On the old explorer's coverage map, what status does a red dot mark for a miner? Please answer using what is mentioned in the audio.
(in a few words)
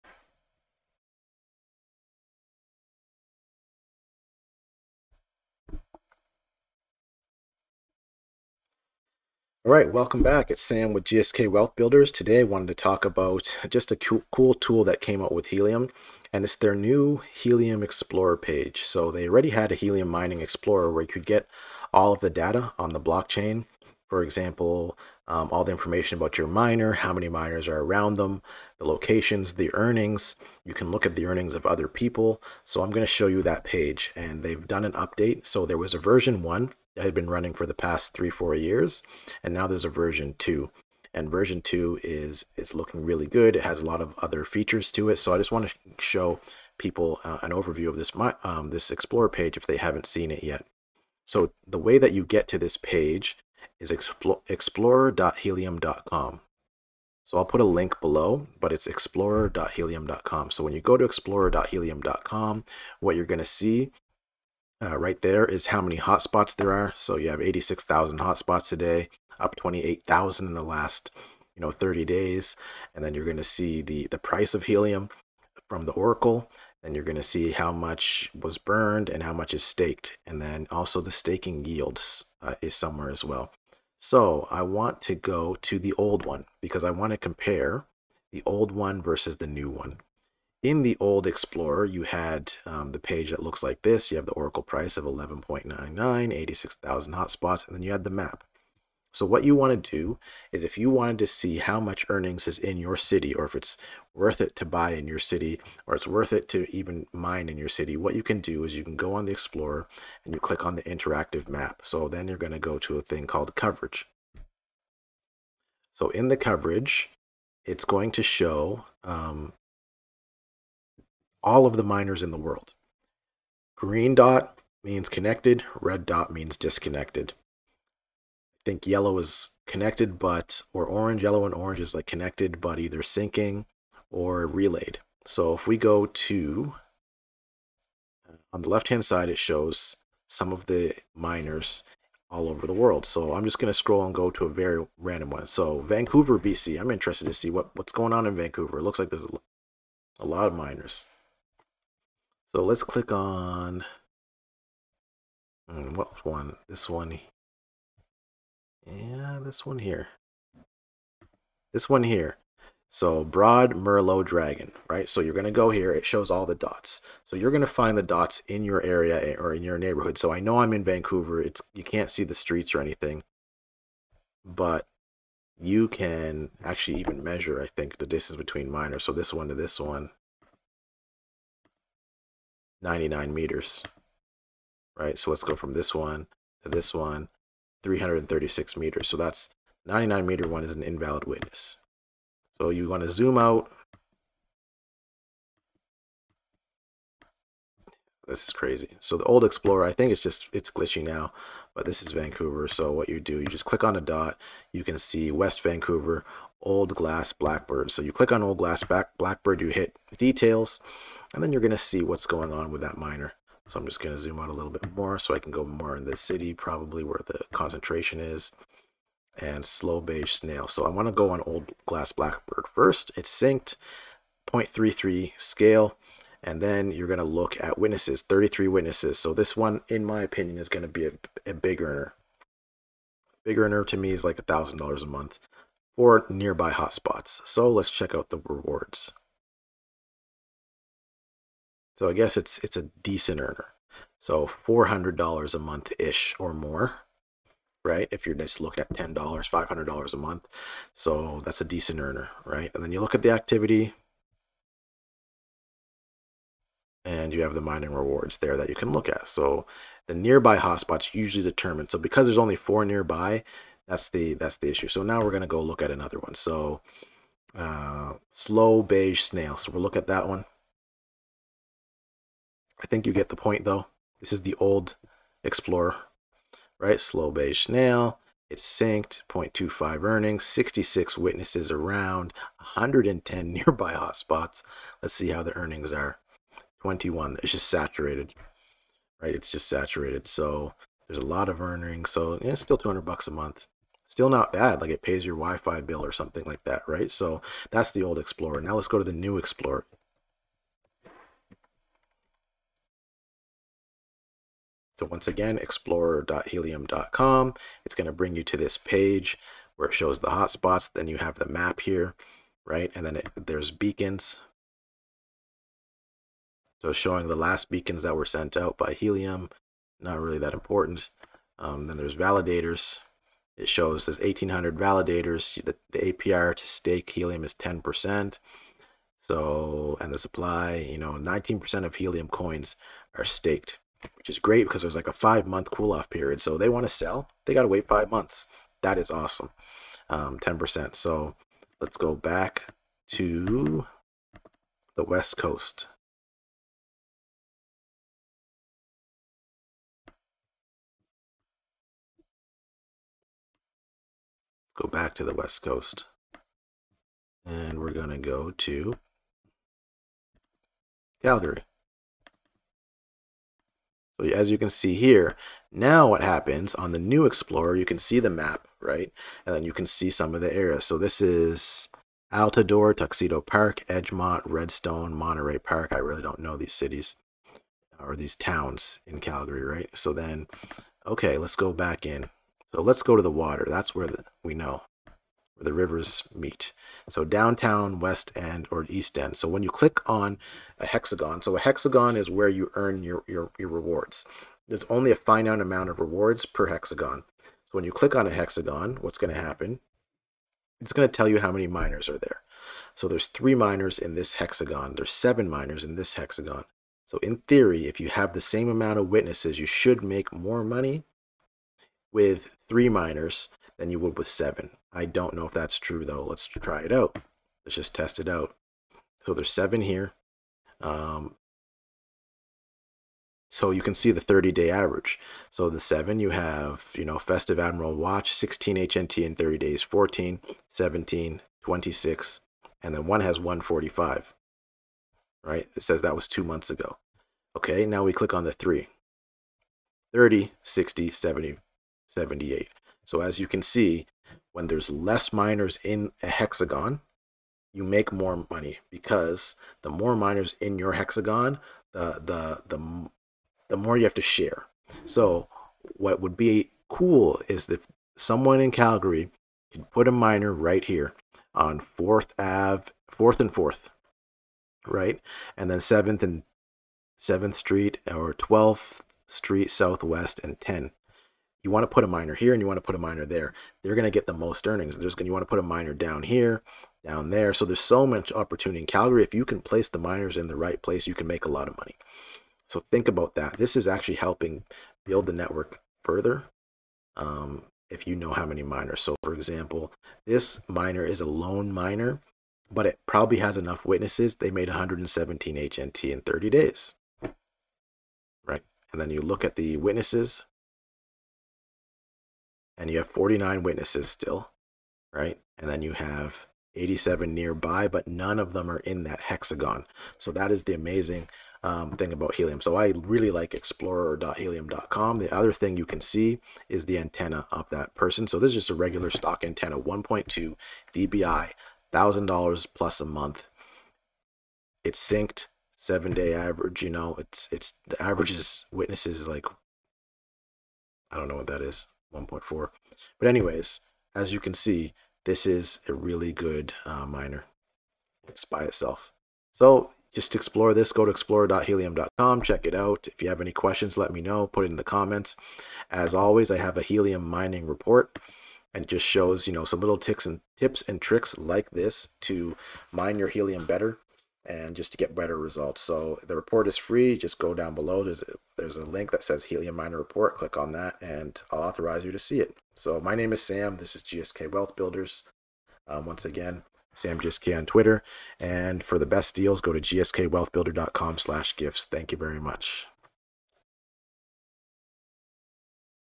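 disconnected.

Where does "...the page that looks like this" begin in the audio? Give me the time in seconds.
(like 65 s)
92 s.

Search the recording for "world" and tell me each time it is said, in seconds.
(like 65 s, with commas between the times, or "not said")
122 s, 142 s.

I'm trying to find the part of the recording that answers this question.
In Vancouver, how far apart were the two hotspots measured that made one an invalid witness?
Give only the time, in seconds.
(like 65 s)
182 s.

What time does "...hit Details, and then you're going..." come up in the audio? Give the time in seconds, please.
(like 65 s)
209 s.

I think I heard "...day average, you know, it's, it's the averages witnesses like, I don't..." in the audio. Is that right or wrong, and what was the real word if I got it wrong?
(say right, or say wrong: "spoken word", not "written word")
right.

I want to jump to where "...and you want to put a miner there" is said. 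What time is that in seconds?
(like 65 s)
472 s.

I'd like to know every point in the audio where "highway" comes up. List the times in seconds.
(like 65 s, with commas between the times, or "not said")
not said.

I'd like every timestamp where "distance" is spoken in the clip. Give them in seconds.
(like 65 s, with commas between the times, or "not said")
178 s.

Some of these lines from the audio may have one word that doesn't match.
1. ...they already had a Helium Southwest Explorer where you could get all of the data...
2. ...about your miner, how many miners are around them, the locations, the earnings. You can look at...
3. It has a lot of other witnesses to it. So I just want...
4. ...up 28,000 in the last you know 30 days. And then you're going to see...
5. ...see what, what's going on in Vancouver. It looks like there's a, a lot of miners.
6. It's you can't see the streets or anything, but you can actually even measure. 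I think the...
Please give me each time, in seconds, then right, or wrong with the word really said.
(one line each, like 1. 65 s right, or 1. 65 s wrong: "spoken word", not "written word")
1. 19 s wrong: "Mining", not "Southwest"
2. 26 s right
3. 43 s wrong: "features", not "witnesses"
4. 69 s right
5. 147 s right
6. 171 s right.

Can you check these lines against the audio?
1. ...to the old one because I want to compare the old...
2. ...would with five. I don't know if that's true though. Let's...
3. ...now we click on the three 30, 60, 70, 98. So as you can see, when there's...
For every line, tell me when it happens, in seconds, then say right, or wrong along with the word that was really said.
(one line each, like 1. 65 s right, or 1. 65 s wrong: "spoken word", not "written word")
1. 85 s right
2. 413 s wrong: "seven", not "five"
3. 437 s wrong: "78", not "98".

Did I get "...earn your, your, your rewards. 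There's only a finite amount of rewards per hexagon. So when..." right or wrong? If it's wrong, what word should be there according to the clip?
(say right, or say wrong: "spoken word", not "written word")
right.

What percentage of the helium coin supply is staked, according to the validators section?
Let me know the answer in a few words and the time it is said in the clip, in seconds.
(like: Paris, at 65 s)
19%, at 331 s.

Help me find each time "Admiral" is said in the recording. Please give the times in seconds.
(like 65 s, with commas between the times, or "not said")
427 s.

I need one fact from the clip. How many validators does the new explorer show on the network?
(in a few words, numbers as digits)
1,800.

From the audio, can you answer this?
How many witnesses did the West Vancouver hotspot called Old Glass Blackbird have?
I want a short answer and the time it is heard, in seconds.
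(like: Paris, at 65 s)
33, at 228 s.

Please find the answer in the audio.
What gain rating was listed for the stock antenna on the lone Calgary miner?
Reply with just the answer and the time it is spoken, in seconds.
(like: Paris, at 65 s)
1.2 dBi, at 519 s.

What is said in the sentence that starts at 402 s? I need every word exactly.
So there's three miners in this hexagon.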